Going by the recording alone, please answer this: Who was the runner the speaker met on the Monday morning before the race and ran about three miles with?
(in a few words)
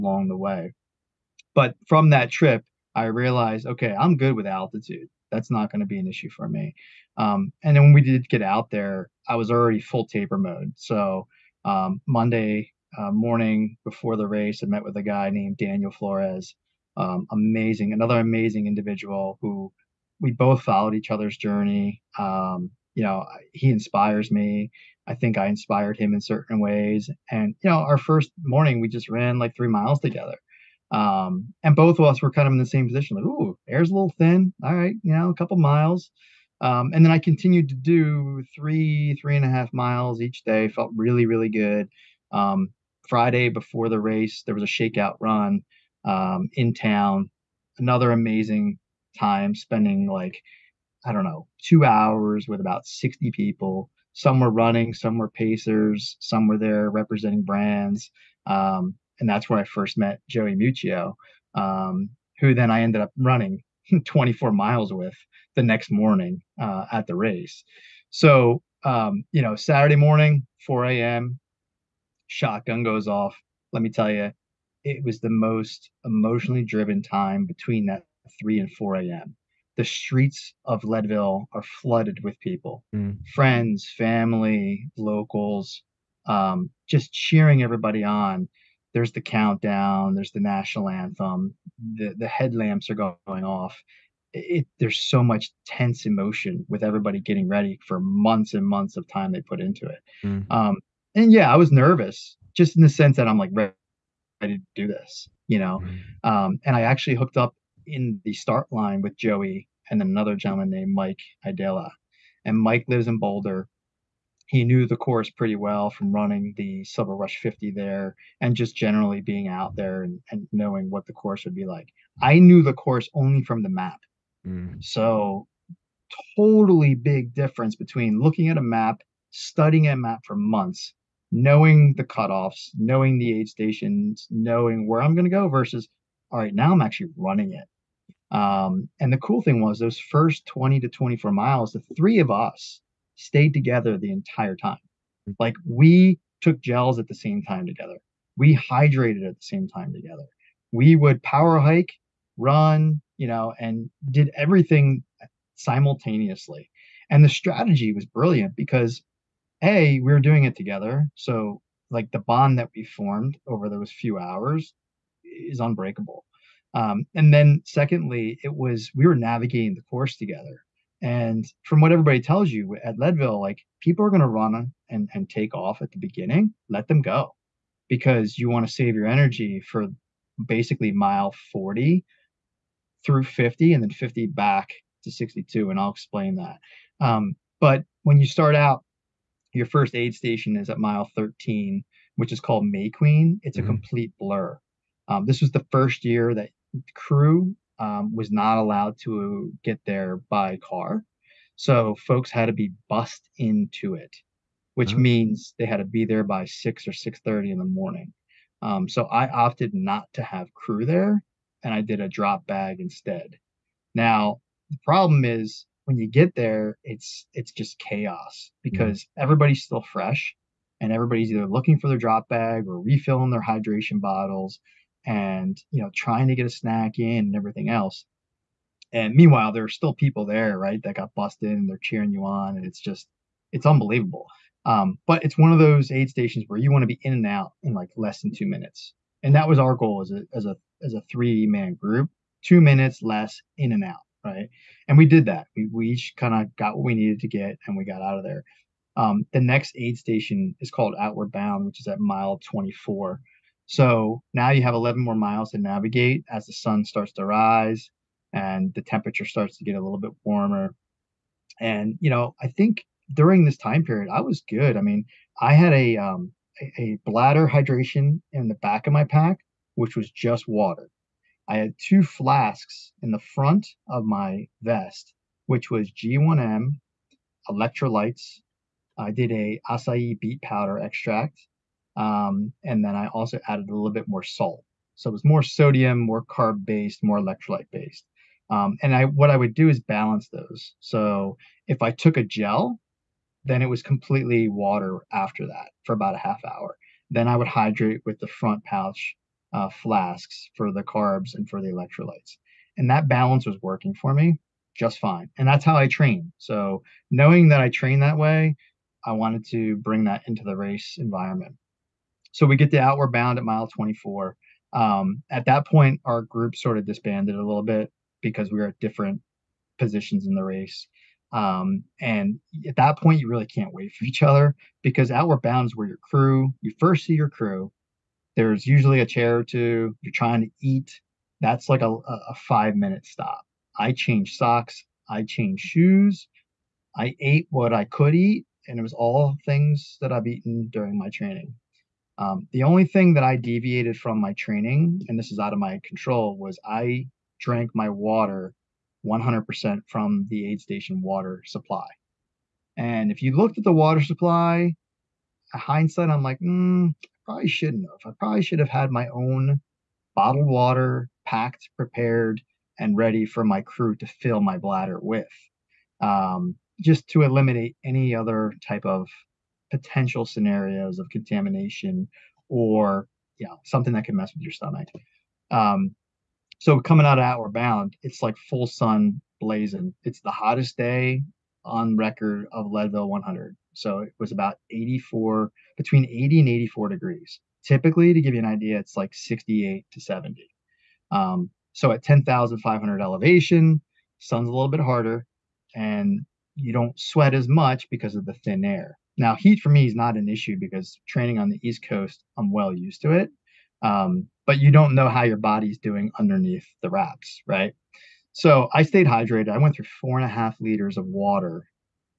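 Daniel Flores.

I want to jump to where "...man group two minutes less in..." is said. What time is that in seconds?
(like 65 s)
241 s.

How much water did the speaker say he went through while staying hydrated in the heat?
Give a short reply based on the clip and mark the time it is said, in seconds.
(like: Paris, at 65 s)
4.5 liters, at 409 s.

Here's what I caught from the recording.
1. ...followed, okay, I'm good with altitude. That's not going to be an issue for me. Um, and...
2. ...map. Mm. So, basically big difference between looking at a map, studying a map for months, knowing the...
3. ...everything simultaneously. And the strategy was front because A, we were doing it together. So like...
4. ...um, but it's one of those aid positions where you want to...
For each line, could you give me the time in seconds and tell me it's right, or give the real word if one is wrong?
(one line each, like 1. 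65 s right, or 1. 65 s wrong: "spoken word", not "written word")
1. 3 s wrong: "realized", not "followed"
2. 123 s wrong: "totally", not "basically"
3. 154 s wrong: "brilliant", not "front"
4. 234 s wrong: "stations", not "positions".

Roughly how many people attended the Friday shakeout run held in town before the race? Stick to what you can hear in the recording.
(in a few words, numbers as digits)
60.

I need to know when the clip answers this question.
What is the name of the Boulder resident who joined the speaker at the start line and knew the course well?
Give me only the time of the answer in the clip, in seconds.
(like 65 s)
110 s.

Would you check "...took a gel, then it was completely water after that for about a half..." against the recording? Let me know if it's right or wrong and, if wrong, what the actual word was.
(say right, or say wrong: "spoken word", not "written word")
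right.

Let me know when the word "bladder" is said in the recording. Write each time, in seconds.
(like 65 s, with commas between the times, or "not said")
267 s, 364 s.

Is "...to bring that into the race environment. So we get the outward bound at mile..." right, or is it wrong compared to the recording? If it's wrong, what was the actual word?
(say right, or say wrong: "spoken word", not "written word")
right.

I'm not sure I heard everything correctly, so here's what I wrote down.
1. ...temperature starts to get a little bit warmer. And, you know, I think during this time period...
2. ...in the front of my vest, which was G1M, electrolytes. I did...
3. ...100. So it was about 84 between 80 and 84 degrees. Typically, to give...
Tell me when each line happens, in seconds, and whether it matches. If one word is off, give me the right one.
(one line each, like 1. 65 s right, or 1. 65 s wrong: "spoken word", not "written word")
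1. 258 s right
2. 273 s right
3. 383 s right.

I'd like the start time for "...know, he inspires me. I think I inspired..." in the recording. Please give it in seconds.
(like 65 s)
23 s.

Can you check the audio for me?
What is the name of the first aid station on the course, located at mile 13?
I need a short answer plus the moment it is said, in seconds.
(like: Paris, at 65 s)
May Queen, at 192 s.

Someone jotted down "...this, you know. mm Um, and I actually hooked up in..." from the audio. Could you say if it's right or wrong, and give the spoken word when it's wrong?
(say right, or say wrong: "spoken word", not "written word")
right.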